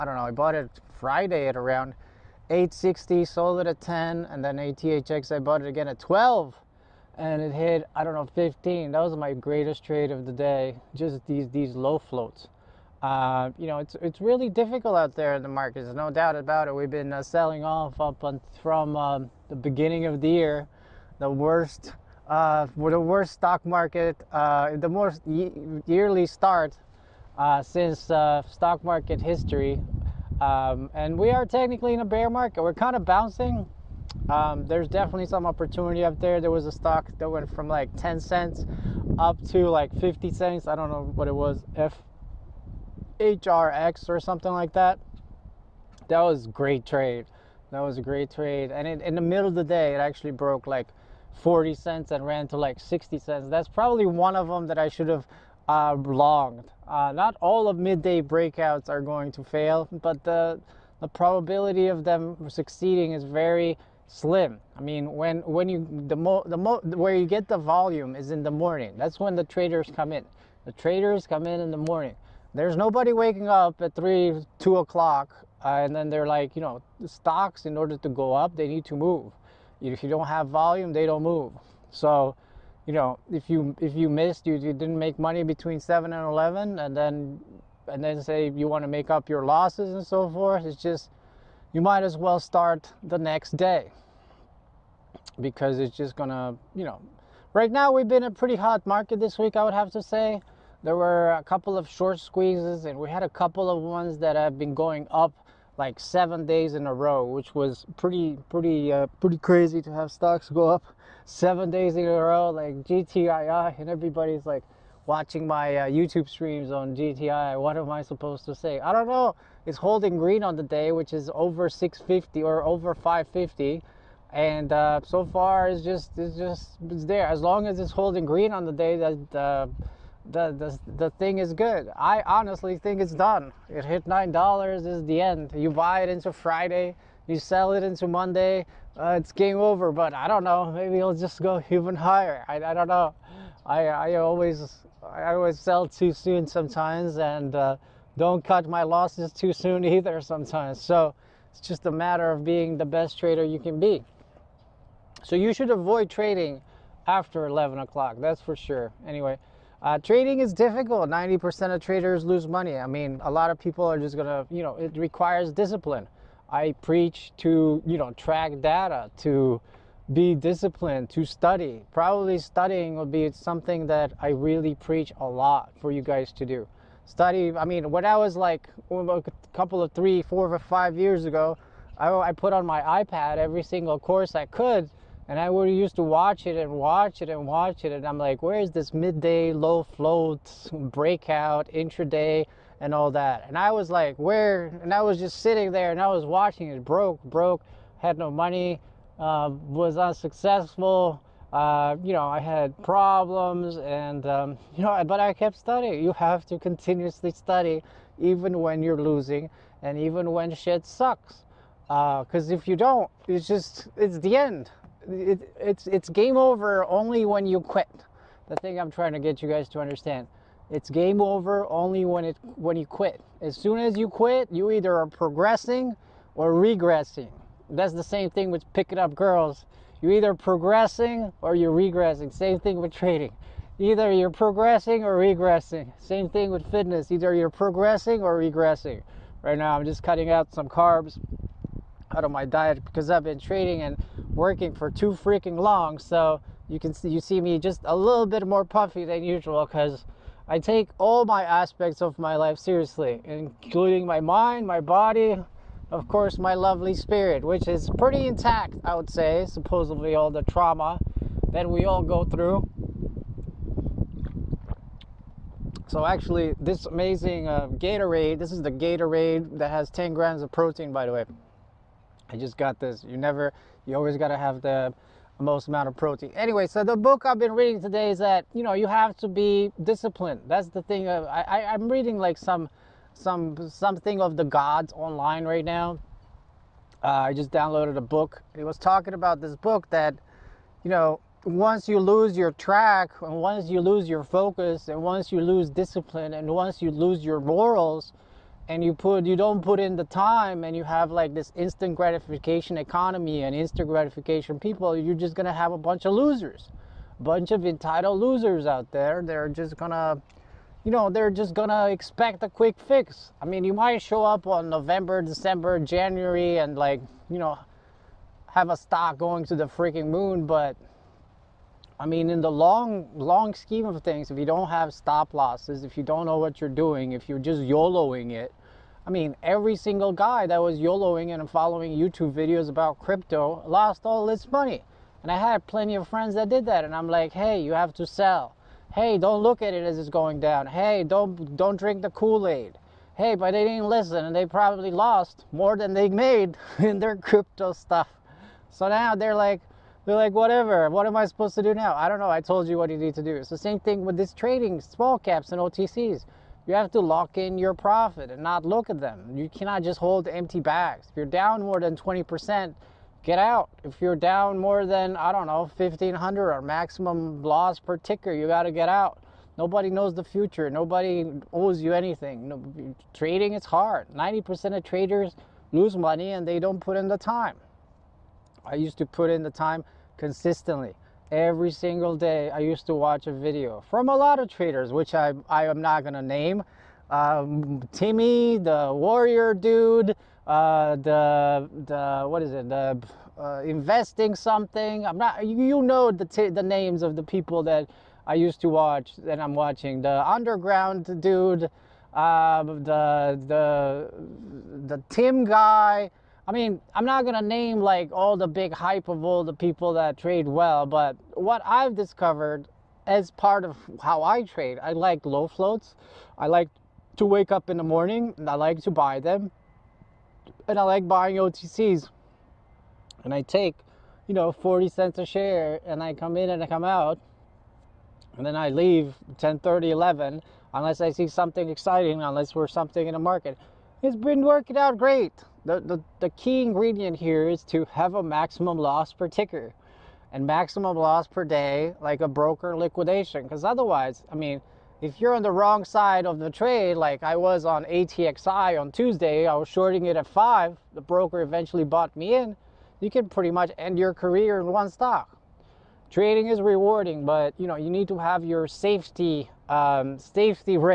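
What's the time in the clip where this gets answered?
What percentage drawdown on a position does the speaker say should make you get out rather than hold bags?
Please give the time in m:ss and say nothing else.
6:01.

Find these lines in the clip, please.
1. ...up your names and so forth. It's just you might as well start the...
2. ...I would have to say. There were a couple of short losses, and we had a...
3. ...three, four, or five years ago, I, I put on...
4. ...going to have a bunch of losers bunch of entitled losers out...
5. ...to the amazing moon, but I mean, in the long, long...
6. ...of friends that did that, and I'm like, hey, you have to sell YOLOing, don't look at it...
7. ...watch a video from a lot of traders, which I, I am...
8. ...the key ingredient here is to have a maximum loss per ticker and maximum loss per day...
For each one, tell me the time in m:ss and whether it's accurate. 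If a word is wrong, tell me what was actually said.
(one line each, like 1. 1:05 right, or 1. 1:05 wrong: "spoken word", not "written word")
1. 1:29 wrong: "losses", not "names"
2. 1:39 wrong: "squeezes", not "losses"
3. 2:59 right
4. 5:05 right
5. 5:19 wrong: "freaking", not "amazing"
6. 5:35 wrong: "Hey", not "YOLOing"
7. 6:22 right
8. 7:16 right.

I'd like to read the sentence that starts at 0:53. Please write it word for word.
That's probably one of them that I should have uh, longed.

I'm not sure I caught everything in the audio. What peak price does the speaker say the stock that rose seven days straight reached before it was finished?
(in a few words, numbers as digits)
$9.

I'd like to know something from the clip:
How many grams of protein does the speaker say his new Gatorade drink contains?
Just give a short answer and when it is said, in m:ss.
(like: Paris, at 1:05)
10, at 4:29.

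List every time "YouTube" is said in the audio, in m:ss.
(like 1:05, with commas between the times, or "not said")
1:55, 5:31.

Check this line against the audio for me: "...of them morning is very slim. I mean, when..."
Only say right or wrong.
wrong.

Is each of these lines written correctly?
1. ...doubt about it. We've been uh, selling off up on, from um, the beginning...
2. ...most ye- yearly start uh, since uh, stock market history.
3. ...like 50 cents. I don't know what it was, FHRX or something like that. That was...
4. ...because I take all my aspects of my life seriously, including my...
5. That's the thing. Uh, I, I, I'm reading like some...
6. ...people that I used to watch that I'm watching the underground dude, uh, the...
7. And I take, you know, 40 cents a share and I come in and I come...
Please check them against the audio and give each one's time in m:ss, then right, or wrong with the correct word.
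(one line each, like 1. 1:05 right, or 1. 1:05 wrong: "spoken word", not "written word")
1. 0:16 right
2. 0:24 right
3. 0:39 right
4. 4:09 right
5. 4:40 right
6. 6:37 right
7. 7:03 right.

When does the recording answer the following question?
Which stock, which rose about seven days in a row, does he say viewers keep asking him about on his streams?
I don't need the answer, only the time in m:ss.
1:52.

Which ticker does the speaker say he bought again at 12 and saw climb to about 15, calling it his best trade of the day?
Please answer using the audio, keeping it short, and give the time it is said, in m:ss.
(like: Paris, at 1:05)
ATHX, at 0:04.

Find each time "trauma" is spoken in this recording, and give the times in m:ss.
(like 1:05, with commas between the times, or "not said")
4:20.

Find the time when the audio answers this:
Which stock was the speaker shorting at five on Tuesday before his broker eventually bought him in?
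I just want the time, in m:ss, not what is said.
7:27.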